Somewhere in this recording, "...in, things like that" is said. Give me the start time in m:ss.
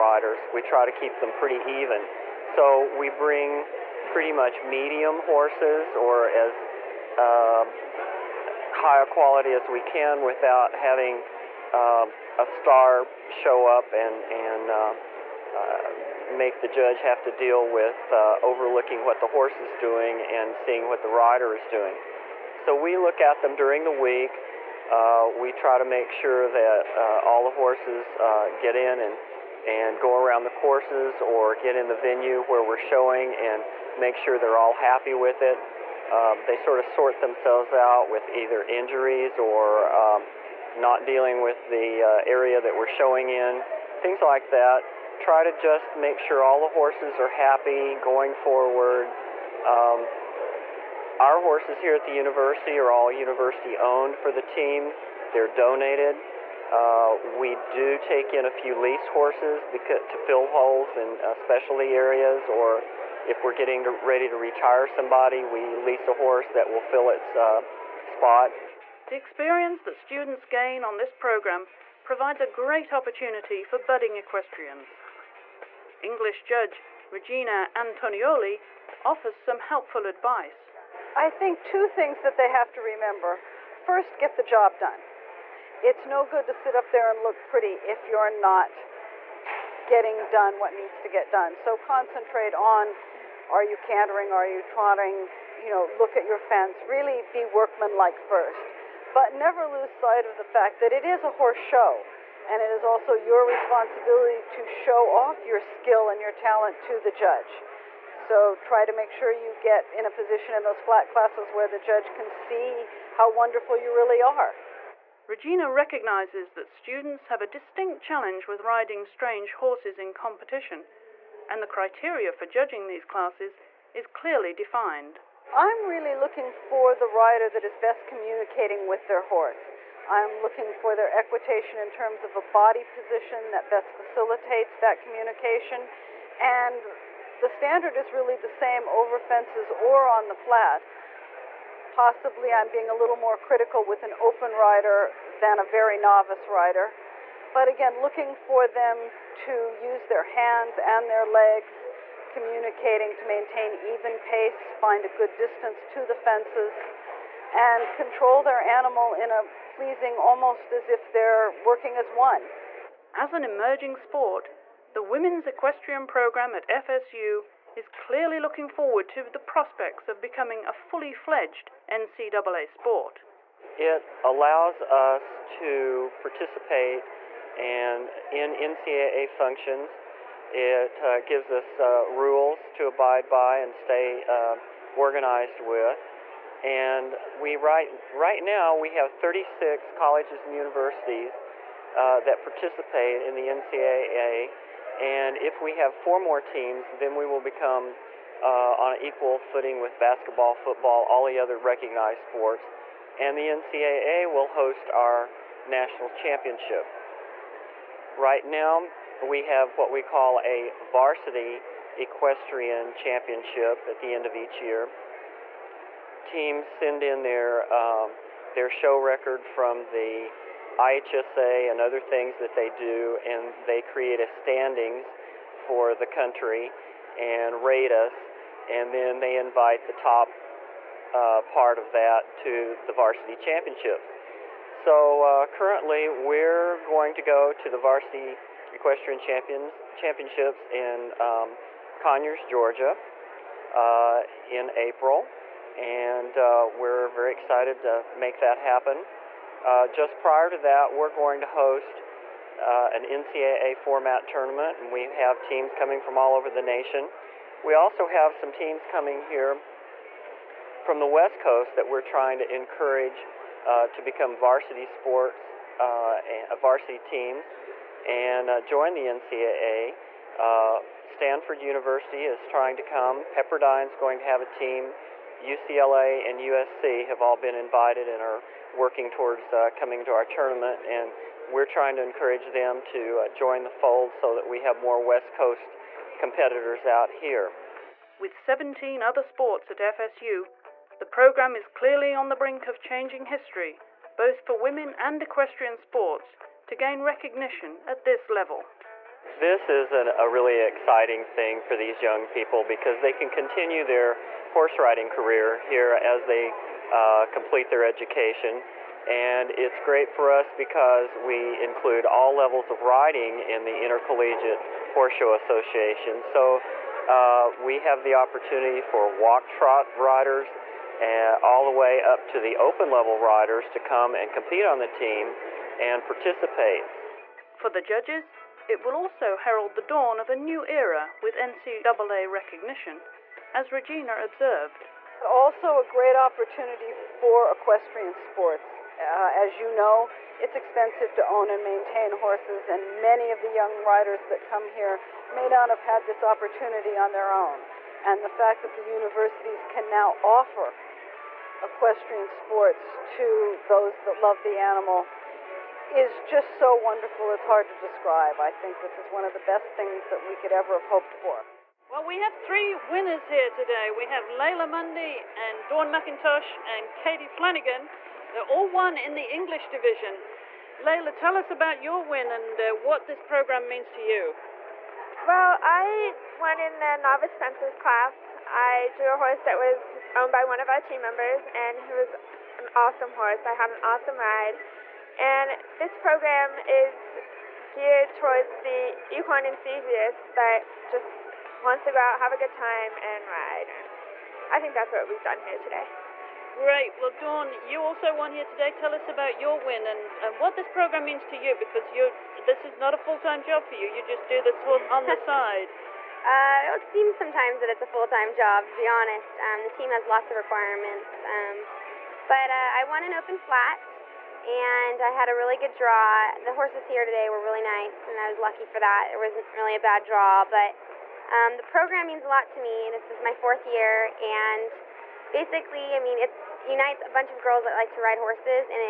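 0:43.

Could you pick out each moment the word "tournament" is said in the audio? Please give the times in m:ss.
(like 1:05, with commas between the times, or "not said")
4:14, 4:40.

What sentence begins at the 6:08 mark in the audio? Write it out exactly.
They're all won in the English division.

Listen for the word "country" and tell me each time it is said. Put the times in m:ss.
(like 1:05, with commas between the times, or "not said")
3:46.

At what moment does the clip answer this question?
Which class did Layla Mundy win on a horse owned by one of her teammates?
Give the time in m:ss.
6:16.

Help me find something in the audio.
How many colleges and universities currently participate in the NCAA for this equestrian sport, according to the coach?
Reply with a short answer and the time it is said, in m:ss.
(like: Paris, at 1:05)
36, at 3:09.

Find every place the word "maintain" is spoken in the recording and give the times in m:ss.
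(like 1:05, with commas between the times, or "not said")
2:33, 5:41.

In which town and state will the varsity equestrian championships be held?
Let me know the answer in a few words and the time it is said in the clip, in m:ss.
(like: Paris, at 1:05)
Conyers, Georgia, at 4:01.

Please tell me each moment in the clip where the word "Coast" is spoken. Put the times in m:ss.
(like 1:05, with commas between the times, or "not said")
4:21, 4:45.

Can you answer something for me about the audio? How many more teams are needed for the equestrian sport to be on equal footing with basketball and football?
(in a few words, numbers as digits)
4.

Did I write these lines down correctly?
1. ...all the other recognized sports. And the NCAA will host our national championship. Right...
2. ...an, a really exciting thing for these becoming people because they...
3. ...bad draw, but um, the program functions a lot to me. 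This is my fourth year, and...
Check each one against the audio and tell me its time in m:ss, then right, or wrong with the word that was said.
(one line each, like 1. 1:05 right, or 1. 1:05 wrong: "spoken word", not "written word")
1. 3:21 right
2. 4:59 wrong: "young", not "becoming"
3. 6:59 wrong: "means", not "functions".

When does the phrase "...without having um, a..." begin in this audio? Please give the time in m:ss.
0:10.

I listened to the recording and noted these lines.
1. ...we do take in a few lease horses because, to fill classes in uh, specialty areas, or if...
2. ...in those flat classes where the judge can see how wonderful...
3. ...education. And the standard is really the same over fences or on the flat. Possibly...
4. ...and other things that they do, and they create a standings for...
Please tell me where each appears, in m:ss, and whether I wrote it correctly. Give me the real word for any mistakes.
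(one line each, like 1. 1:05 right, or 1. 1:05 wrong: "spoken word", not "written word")
1. 0:57 wrong: "holes", not "classes"
2. 1:50 right
3. 2:15 wrong: "communication", not "education"
4. 3:41 right.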